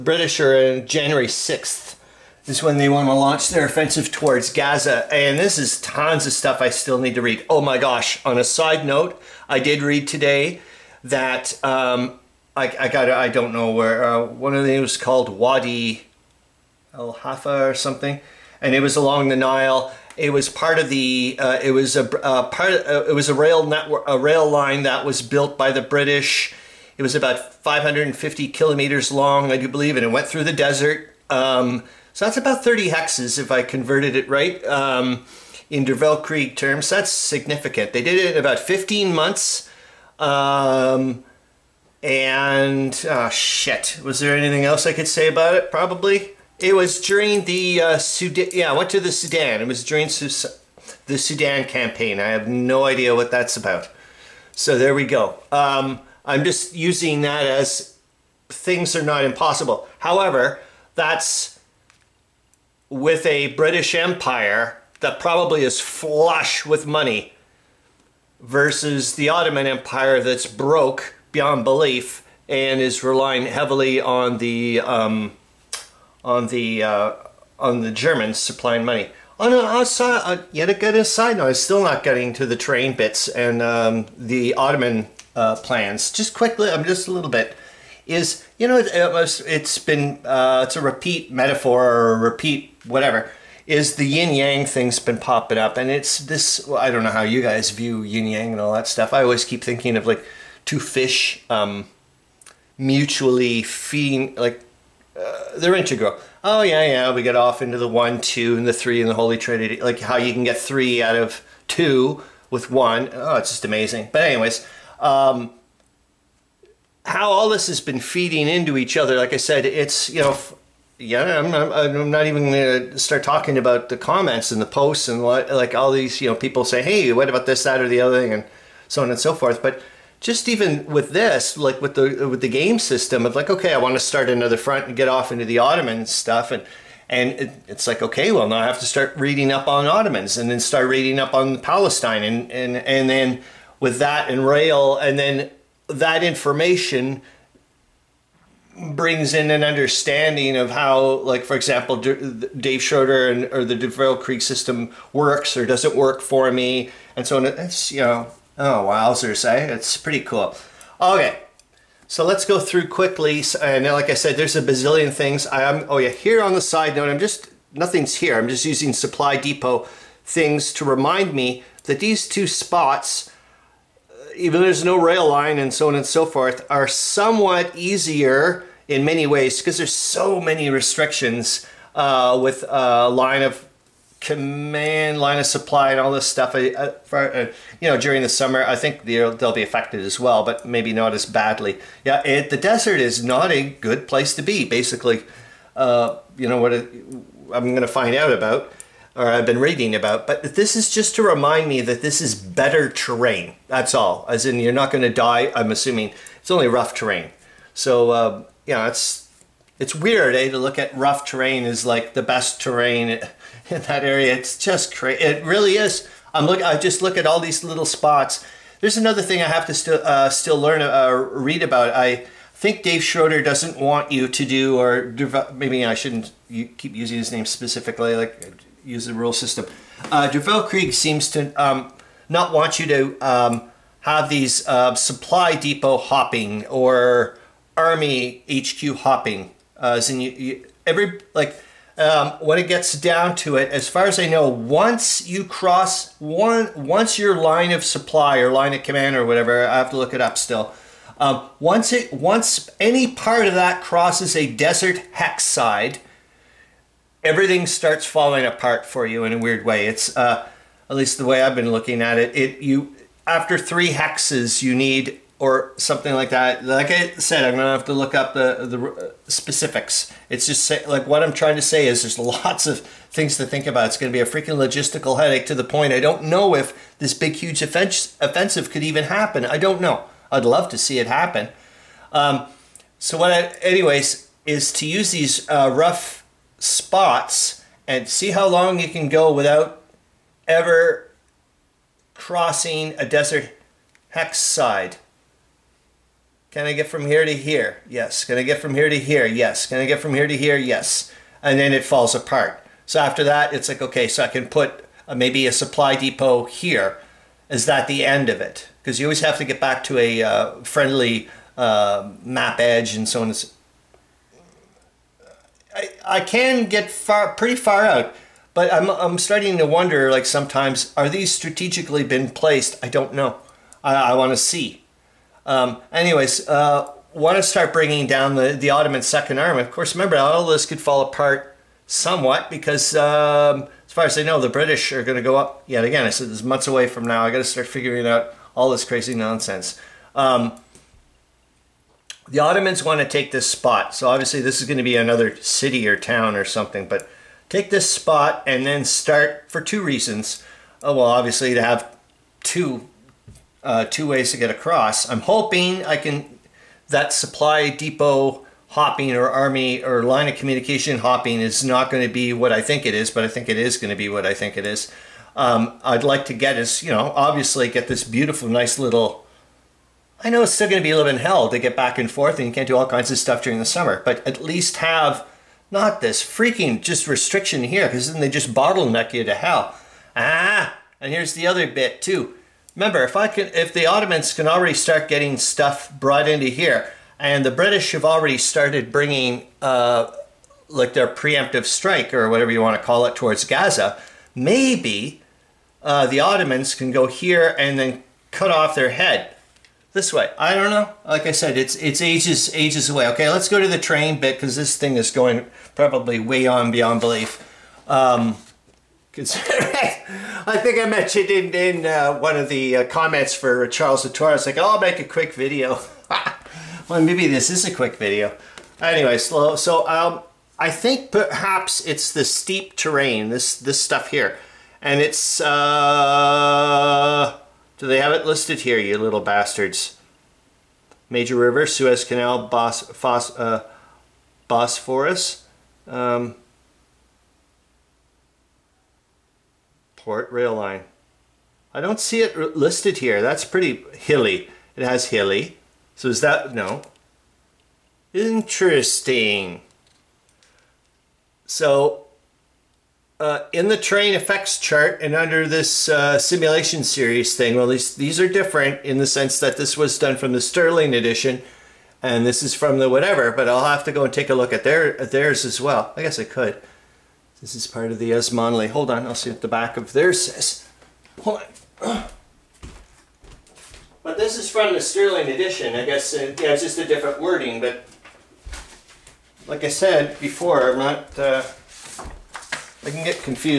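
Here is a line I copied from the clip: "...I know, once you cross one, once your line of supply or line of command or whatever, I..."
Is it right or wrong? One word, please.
right.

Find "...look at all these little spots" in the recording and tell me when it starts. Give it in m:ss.
3:37.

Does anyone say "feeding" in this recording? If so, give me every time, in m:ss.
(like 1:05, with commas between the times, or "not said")
1:43, 1:57.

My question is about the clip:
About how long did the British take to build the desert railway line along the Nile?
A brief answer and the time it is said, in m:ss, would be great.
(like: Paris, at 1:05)
15 months, at 0:38.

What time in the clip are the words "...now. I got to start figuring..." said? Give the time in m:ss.
5:37.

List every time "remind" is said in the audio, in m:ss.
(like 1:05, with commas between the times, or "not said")
2:50, 3:21.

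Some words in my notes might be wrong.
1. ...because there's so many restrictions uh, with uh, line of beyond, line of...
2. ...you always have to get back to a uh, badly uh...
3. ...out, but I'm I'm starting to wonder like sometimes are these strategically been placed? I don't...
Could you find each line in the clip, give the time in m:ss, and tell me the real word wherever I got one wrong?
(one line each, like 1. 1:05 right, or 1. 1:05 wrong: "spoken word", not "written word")
1. 2:59 wrong: "command", not "beyond"
2. 5:08 wrong: "friendly", not "badly"
3. 5:17 right.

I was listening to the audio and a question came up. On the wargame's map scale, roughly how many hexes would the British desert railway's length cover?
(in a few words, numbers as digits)
30 hexes.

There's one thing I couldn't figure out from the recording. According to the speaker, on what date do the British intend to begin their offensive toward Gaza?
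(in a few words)
January 6th.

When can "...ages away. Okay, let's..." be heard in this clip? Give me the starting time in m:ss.
6:42.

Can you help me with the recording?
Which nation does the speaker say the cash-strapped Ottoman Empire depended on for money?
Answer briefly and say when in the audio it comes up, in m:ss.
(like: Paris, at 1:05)
Germans, at 1:17.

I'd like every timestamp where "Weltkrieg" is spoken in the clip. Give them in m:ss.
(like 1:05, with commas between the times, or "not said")
0:35, 2:33.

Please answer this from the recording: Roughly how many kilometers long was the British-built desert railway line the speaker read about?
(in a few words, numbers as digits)
550 kilometers.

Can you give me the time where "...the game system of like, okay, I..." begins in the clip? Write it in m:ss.
2:12.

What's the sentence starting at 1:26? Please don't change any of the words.
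Just quickly, I'm just a little bit.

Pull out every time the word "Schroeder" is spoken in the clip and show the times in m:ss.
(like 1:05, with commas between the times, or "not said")
2:32, 3:43.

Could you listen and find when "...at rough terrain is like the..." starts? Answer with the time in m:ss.
3:30.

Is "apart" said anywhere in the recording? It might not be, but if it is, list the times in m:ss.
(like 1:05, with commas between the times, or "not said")
4:18, 5:02, 5:31.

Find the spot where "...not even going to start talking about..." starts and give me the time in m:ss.
2:02.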